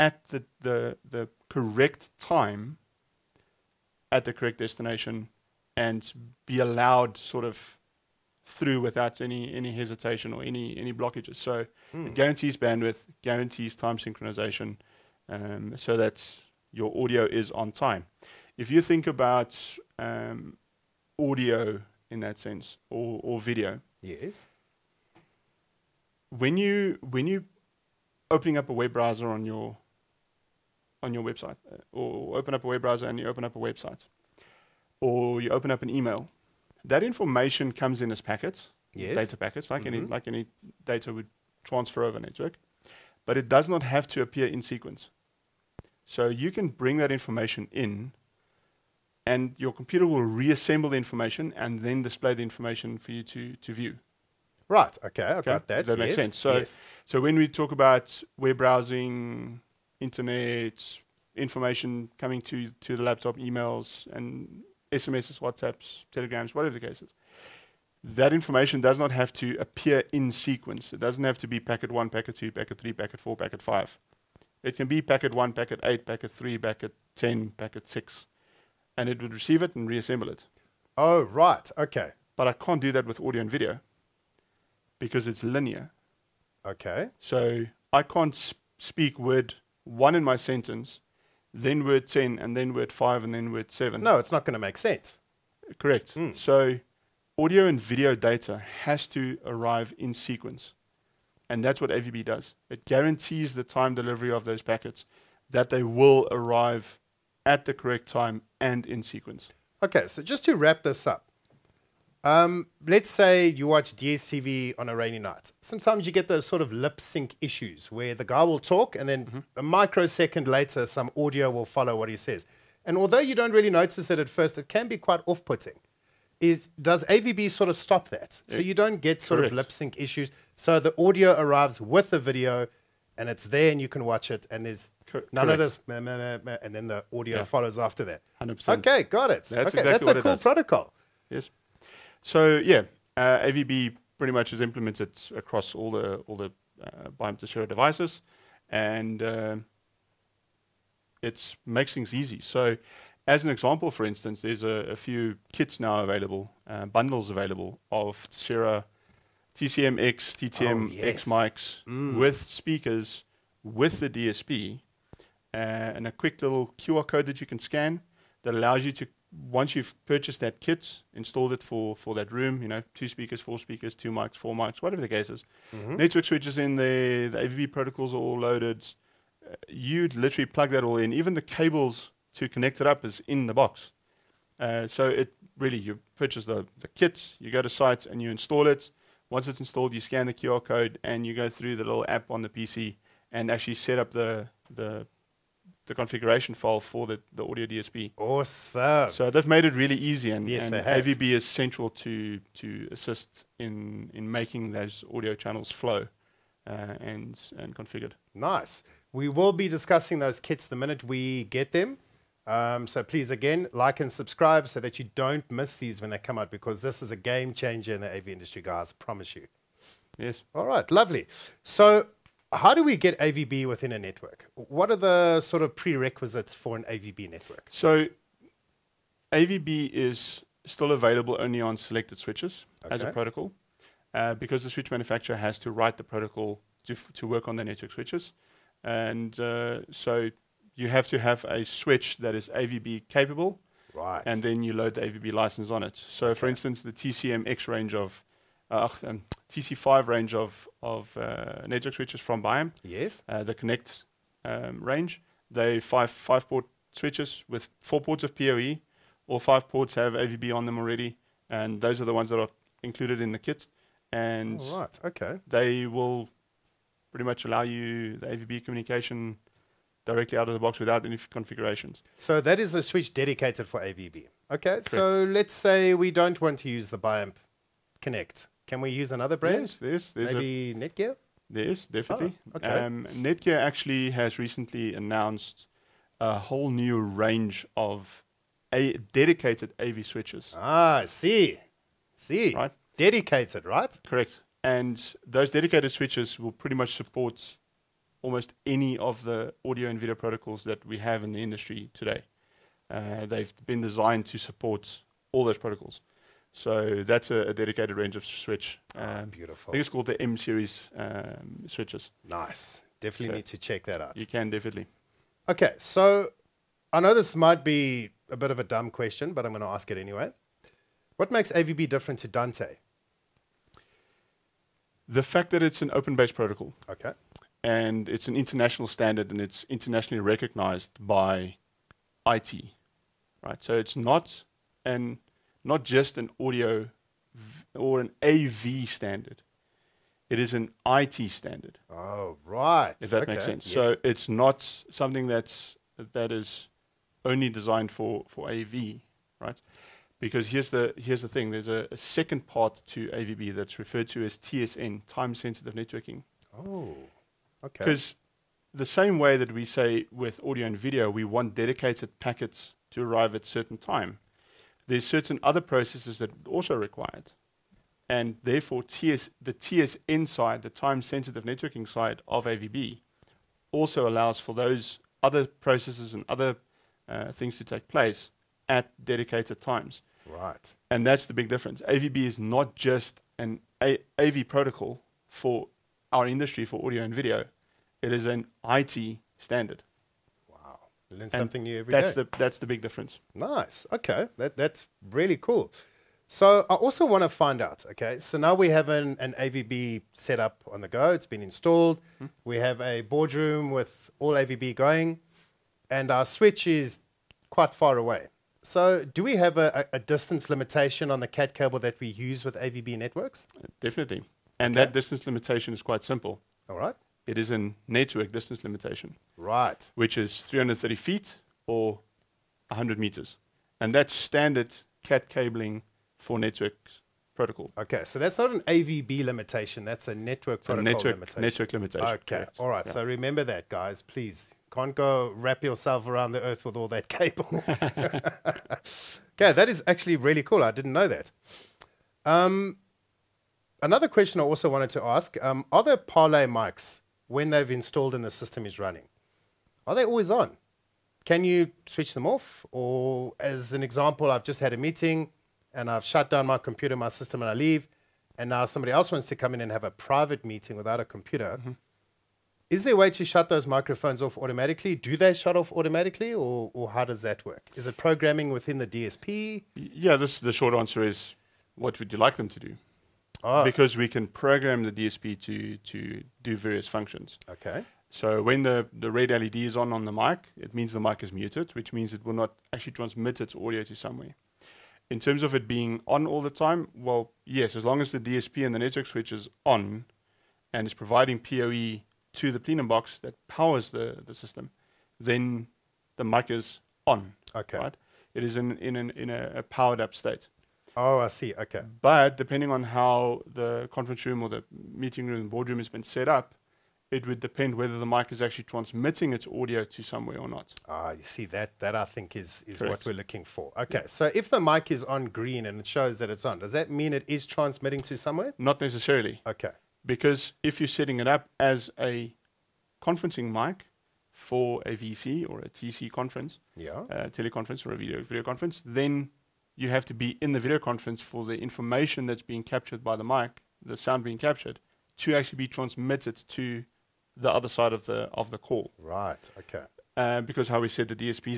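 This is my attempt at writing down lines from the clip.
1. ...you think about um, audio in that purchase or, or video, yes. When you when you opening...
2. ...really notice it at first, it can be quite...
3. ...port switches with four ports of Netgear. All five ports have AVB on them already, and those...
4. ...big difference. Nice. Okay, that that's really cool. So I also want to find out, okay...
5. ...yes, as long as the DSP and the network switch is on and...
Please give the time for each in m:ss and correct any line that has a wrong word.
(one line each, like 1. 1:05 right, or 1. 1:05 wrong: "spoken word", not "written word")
1. 0:18 wrong: "sense", not "purchase"
2. 2:03 right
3. 4:16 wrong: "PoE", not "Netgear"
4. 6:32 right
5. 8:07 right.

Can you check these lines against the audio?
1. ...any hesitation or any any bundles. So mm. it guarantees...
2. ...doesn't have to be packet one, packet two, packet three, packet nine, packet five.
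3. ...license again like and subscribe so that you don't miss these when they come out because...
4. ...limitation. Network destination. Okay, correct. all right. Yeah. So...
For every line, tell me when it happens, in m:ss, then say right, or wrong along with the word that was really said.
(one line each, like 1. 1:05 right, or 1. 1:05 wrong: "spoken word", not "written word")
1. 0:09 wrong: "blockages", not "bundles"
2. 1:10 wrong: "four", not "nine"
3. 3:33 wrong: "please", not "license"
4. 7:11 wrong: "limitation", not "destination".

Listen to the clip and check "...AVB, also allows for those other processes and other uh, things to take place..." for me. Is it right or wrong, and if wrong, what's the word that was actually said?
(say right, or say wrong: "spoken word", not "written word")
right.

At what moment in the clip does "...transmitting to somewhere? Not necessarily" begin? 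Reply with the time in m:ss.
8:37.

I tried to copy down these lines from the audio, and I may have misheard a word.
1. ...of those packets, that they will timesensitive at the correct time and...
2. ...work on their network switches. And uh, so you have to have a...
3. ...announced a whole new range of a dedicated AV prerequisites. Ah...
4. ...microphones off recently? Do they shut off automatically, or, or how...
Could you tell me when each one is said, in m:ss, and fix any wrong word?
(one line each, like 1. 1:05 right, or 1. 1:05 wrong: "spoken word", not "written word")
1. 1:44 wrong: "arrive", not "timesensitive"
2. 3:57 right
3. 4:44 wrong: "switches", not "prerequisites"
4. 7:43 wrong: "automatically", not "recently".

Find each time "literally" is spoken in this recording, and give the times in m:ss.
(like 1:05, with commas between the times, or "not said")
3:00.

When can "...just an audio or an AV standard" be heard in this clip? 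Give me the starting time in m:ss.
5:35.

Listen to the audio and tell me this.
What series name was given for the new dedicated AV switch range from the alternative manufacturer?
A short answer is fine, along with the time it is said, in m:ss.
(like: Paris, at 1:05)
M series, at 5:10.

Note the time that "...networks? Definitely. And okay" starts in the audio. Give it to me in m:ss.
6:52.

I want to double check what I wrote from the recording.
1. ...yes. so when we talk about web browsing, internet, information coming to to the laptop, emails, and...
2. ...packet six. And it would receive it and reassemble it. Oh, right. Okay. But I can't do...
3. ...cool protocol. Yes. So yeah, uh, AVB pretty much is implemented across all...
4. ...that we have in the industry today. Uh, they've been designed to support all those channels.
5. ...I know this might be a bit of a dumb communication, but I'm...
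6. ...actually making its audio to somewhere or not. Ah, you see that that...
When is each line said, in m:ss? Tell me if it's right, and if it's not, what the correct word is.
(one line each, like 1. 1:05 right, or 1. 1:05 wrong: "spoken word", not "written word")
1. 0:56 right
2. 1:17 right
3. 2:20 right
4. 5:00 wrong: "protocols", not "channels"
5. 5:16 wrong: "question", not "communication"
6. 8:28 wrong: "transmitting", not "making".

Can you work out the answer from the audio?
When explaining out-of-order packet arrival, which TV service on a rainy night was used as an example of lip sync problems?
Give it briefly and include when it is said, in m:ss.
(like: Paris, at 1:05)
DSTV, at 1:53.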